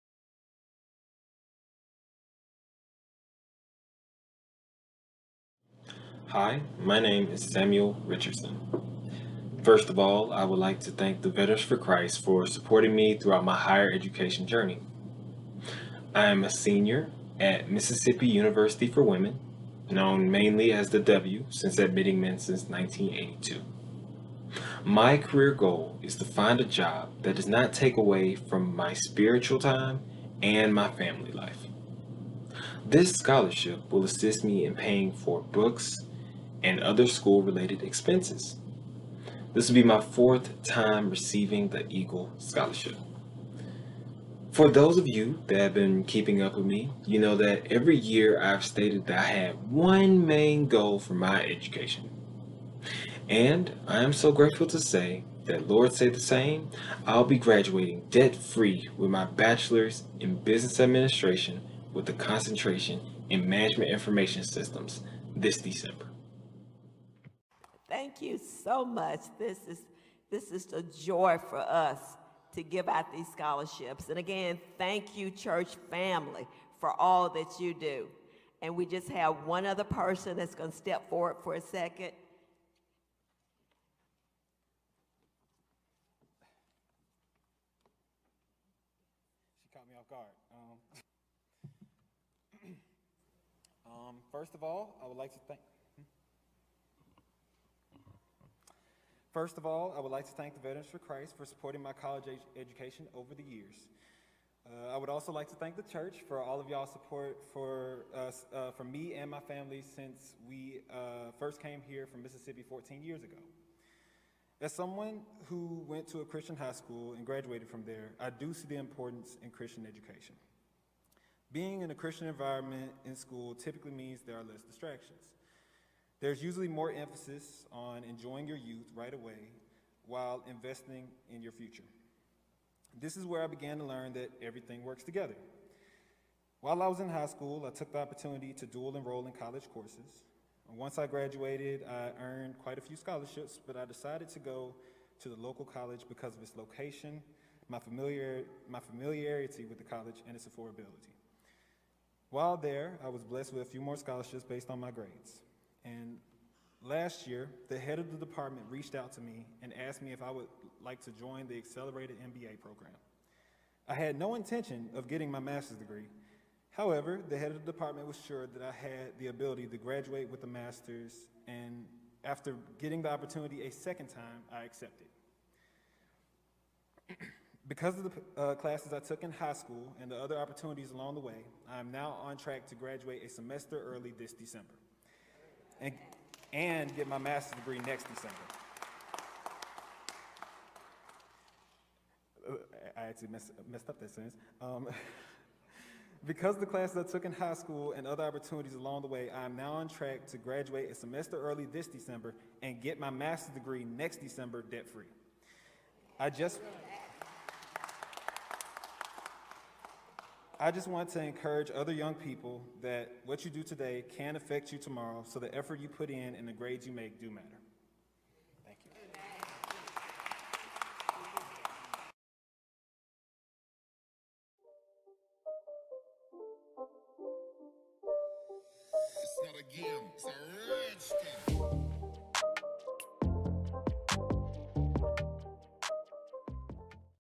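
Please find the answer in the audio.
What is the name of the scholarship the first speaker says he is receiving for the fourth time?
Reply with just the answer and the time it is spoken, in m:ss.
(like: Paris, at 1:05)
Eagle Scholarship, at 0:41.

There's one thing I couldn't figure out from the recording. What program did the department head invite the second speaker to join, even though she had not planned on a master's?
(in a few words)
accelerated MBA program.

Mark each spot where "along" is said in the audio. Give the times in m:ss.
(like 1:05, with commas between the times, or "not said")
3:00, 3:18.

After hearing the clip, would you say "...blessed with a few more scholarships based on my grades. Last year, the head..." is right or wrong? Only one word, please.
right.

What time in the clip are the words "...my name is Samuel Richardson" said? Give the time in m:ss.
0:06.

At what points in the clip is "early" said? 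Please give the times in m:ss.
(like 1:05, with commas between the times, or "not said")
3:03, 3:21.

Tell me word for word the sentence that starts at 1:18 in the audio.
And we just have one other person that's going to step forward for a second.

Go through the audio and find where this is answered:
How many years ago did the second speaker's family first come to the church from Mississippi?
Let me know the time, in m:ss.
1:52.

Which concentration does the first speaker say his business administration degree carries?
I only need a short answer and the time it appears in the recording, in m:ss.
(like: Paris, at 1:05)
management information systems, at 1:03.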